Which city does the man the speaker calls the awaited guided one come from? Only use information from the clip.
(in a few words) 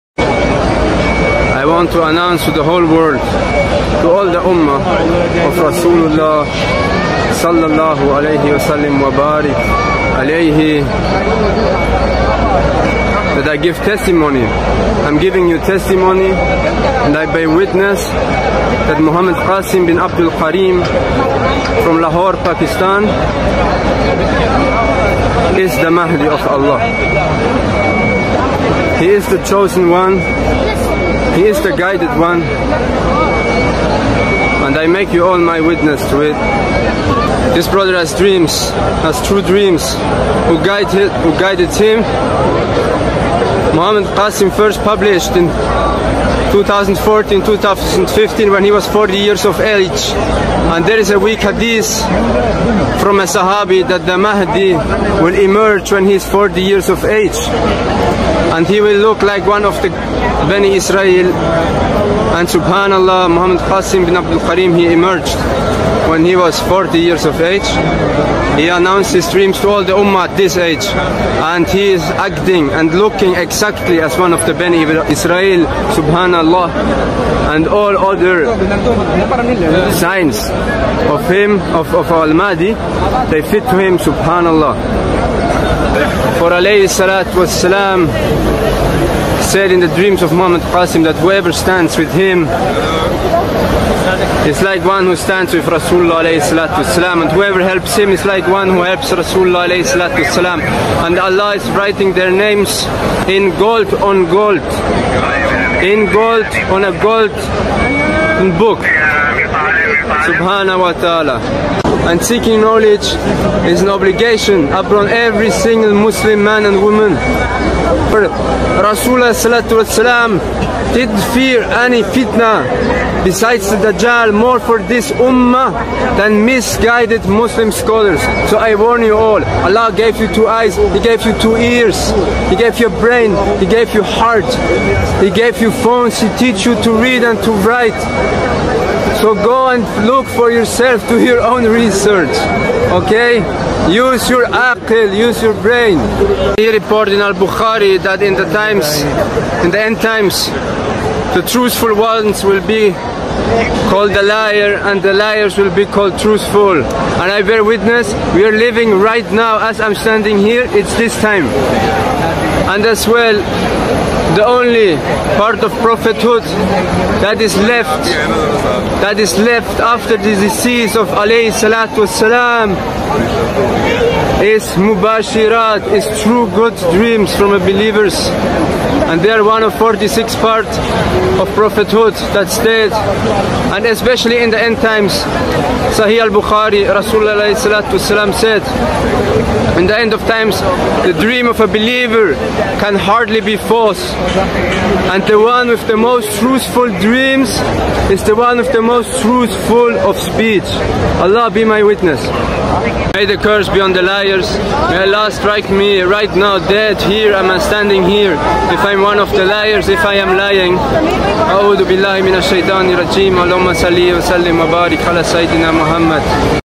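Lahore.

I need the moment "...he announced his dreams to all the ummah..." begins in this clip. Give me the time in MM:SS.
01:08.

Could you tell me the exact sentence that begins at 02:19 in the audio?
So go and look for yourself, do your own research, okay?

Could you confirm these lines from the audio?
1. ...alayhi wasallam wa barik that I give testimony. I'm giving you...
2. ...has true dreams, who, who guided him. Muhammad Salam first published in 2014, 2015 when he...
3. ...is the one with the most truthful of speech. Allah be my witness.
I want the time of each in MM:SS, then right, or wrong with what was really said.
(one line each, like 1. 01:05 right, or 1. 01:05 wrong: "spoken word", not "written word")
1. 00:08 right
2. 00:39 wrong: "Qasim", not "Salam"
3. 03:18 right.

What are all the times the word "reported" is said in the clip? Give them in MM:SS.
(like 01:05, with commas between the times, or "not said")
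02:26.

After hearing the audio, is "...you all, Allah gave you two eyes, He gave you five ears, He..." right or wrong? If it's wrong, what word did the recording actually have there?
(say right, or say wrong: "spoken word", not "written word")
wrong: "two", not "five".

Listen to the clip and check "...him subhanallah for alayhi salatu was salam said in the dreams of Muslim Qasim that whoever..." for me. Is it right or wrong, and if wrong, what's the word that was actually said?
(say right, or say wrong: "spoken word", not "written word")
wrong: "Muhammad", not "Muslim".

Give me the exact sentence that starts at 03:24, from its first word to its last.
May Allah strike me right now dead here.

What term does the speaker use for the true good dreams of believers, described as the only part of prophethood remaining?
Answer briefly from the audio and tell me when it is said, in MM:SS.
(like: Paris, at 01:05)
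Mubashirat, at 02:54.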